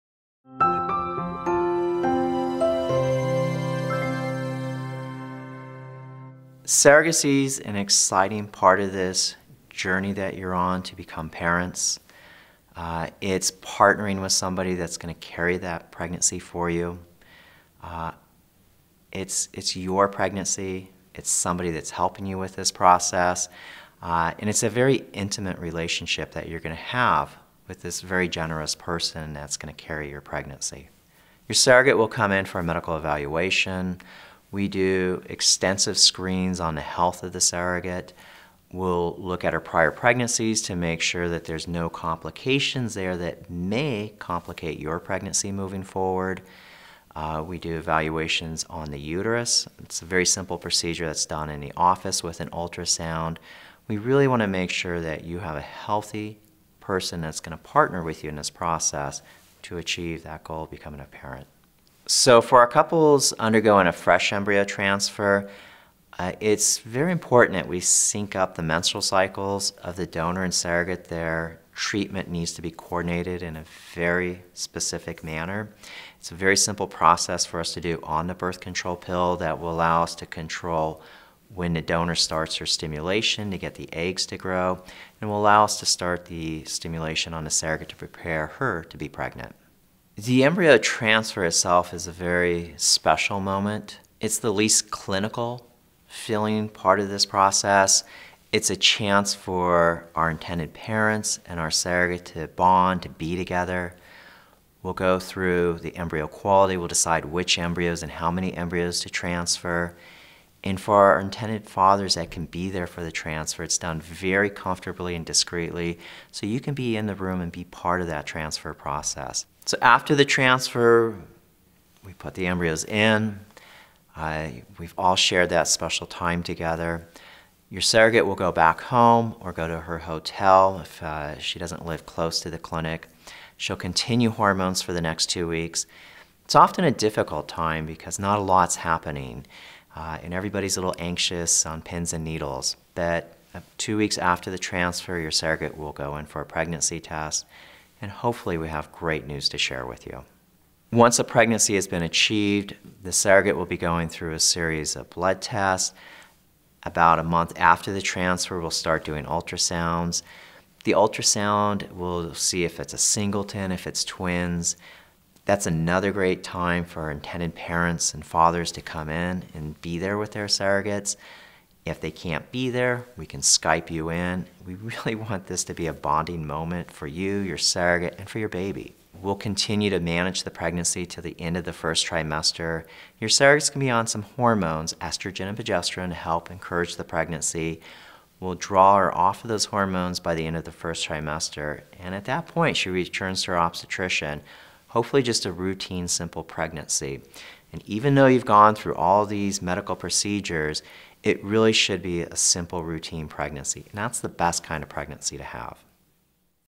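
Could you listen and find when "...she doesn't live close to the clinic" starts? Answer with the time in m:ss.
2:11.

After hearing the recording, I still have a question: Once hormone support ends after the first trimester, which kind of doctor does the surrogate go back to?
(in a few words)
her obstetrician.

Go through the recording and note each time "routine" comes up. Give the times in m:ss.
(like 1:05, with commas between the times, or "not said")
3:15, 3:22.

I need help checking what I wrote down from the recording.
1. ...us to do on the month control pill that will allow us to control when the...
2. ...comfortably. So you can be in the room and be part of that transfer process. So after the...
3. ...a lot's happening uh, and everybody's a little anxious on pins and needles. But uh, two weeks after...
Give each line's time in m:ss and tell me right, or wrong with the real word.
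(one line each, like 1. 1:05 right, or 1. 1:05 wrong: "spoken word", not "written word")
1. 1:17 wrong: "birth", not "month"
2. 1:55 wrong: "discreetly", not "comfortably"
3. 2:18 right.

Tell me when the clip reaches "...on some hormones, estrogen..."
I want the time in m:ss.
3:03.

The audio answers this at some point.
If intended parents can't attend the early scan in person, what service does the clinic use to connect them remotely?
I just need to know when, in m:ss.
2:53.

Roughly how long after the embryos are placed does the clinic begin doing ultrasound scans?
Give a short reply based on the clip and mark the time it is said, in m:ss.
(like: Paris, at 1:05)
about a month, at 2:36.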